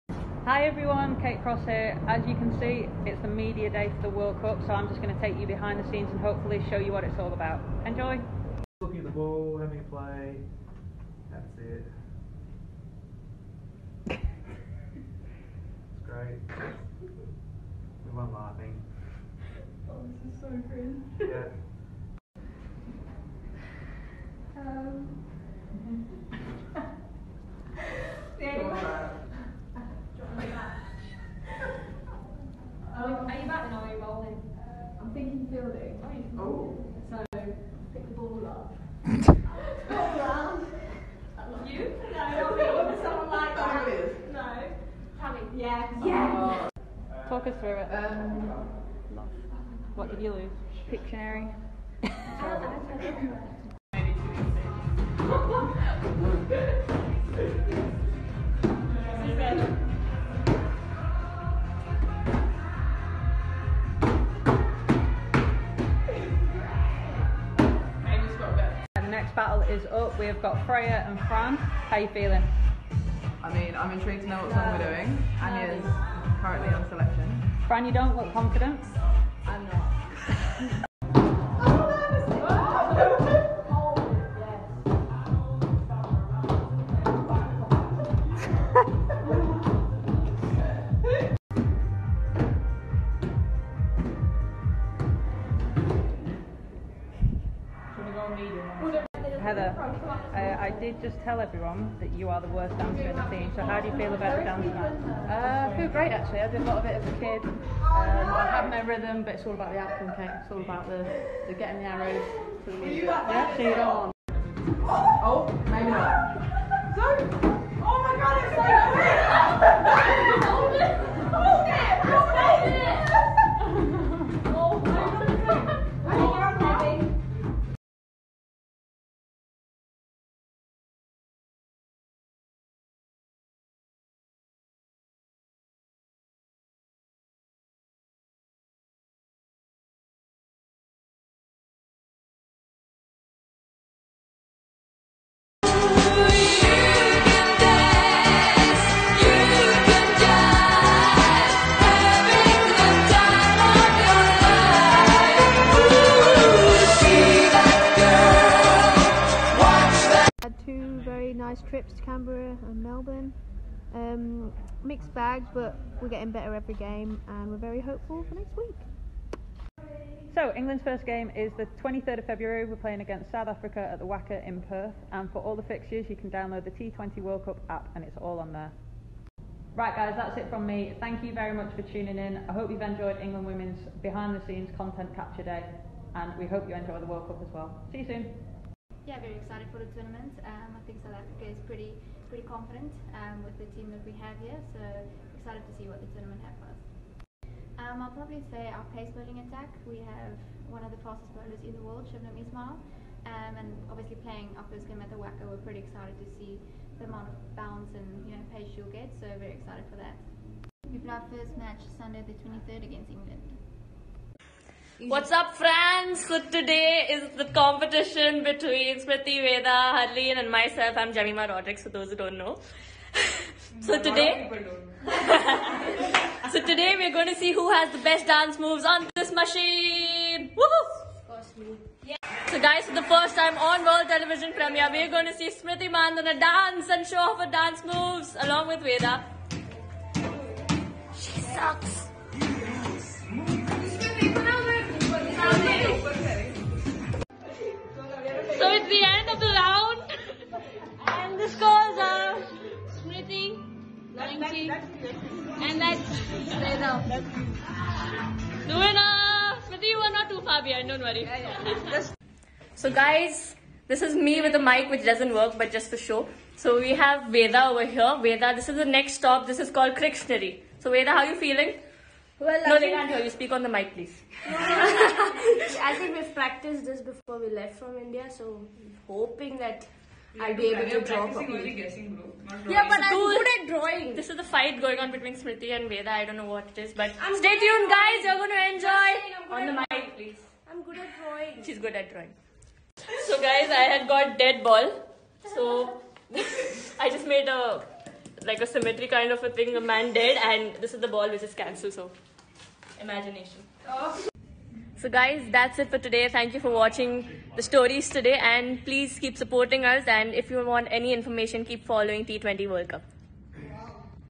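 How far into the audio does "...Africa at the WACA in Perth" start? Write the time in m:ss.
2:53.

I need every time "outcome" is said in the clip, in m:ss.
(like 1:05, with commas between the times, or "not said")
1:49.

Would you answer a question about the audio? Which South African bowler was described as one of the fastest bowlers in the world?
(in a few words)
Shabnim Ismail.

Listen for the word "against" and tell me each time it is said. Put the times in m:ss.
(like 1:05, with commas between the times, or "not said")
2:53, 3:32.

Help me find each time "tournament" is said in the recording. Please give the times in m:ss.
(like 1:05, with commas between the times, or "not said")
3:09, 3:16.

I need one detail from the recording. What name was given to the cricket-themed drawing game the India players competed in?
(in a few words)
Crictionary.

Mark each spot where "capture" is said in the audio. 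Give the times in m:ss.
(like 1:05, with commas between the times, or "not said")
3:05.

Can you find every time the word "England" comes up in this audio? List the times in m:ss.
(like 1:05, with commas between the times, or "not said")
2:50, 3:03, 3:33.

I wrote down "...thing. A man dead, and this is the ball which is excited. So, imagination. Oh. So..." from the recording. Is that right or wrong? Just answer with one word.
wrong.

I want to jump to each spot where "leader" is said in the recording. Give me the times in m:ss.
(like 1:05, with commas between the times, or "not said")
not said.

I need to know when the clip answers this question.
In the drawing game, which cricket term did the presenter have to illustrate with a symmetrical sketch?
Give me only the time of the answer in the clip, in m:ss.
4:54.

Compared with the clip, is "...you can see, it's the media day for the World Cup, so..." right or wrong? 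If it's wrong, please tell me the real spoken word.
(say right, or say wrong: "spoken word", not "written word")
right.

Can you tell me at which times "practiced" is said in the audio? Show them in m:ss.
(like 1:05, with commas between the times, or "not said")
4:36.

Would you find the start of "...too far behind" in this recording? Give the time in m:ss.
4:20.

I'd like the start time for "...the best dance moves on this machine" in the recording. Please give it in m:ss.
3:47.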